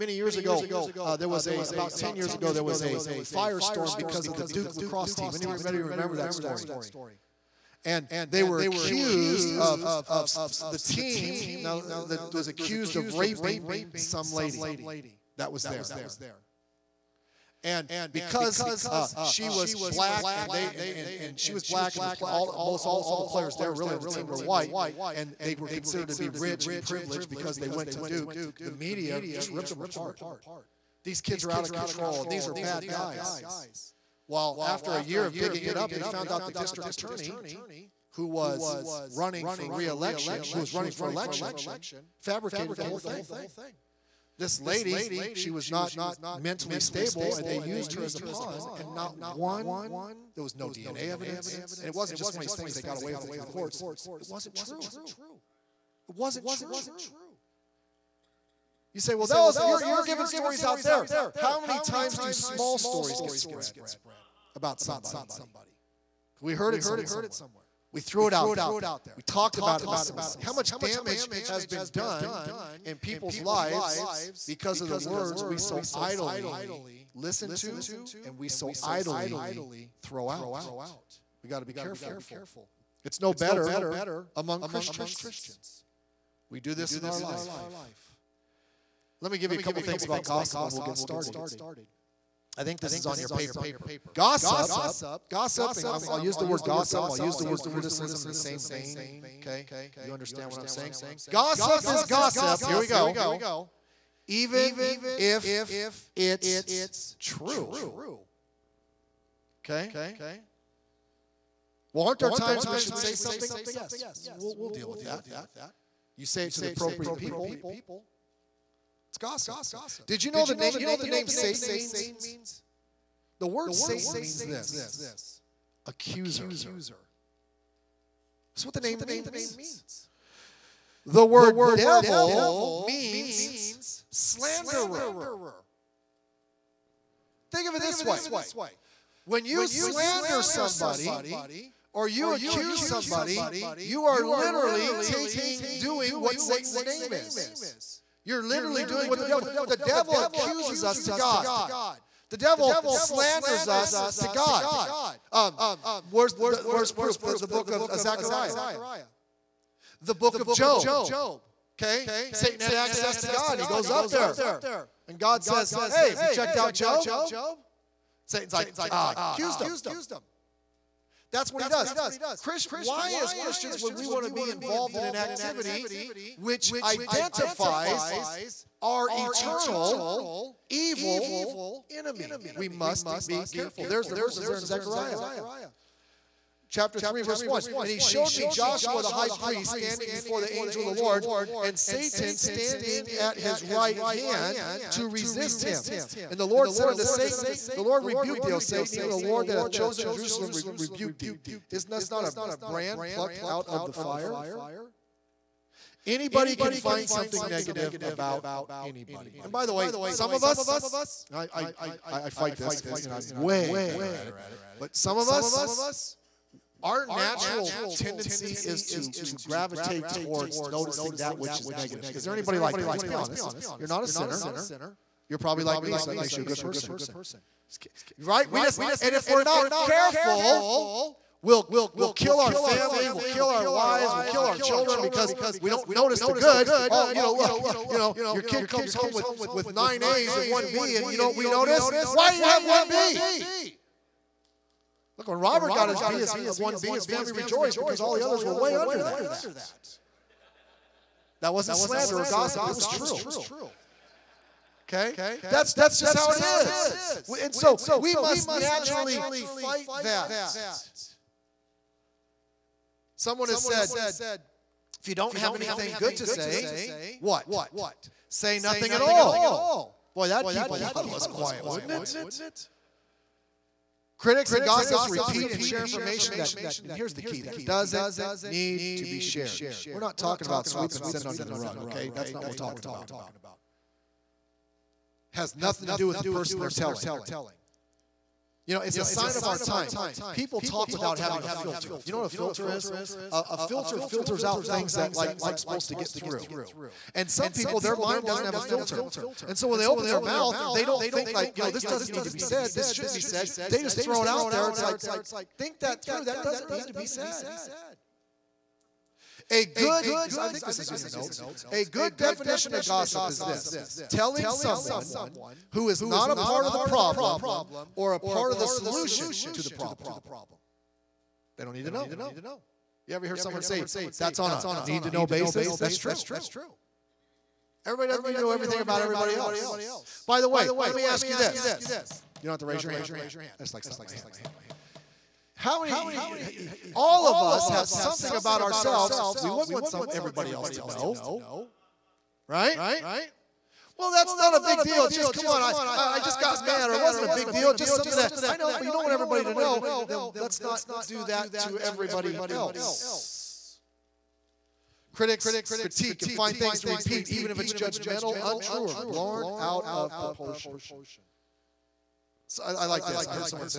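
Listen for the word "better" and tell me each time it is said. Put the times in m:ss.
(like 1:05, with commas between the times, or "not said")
1:23, 3:33.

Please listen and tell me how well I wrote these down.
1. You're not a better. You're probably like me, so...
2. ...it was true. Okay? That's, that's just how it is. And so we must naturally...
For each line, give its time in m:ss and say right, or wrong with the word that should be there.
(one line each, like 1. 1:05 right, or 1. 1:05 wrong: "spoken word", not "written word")
1. 3:43 wrong: "sinner", not "better"
2. 4:12 right.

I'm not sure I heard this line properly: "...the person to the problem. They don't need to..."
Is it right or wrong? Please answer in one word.
wrong.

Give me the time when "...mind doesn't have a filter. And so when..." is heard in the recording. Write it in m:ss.
4:57.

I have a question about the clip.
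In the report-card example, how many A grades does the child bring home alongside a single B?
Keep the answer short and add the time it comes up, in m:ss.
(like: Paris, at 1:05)
9, at 3:59.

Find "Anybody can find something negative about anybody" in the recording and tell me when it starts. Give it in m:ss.
3:26.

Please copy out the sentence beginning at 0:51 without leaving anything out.
And it wasn't just one of these things they got away with it to the courts.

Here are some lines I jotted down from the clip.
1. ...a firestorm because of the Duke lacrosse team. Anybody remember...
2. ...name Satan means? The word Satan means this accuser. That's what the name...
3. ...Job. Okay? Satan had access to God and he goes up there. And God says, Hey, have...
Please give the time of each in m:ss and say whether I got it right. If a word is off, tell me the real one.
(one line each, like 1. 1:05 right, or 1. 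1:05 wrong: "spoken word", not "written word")
1. 0:02 right
2. 2:01 right
3. 2:40 right.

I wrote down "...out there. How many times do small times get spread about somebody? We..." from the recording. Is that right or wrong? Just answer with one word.
wrong.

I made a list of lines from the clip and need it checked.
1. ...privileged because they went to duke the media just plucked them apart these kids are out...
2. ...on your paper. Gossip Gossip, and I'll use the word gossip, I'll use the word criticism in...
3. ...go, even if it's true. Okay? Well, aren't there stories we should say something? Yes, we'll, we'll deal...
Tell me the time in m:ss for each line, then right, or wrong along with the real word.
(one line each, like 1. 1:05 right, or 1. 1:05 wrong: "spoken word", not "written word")
1. 0:26 wrong: "ripped", not "plucked"
2. 1:33 right
3. 1:42 wrong: "times", not "stories".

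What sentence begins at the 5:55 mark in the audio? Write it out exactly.
Critics critique and find things to repeat, even if it's judgmental, untrue, or blown out of proportion.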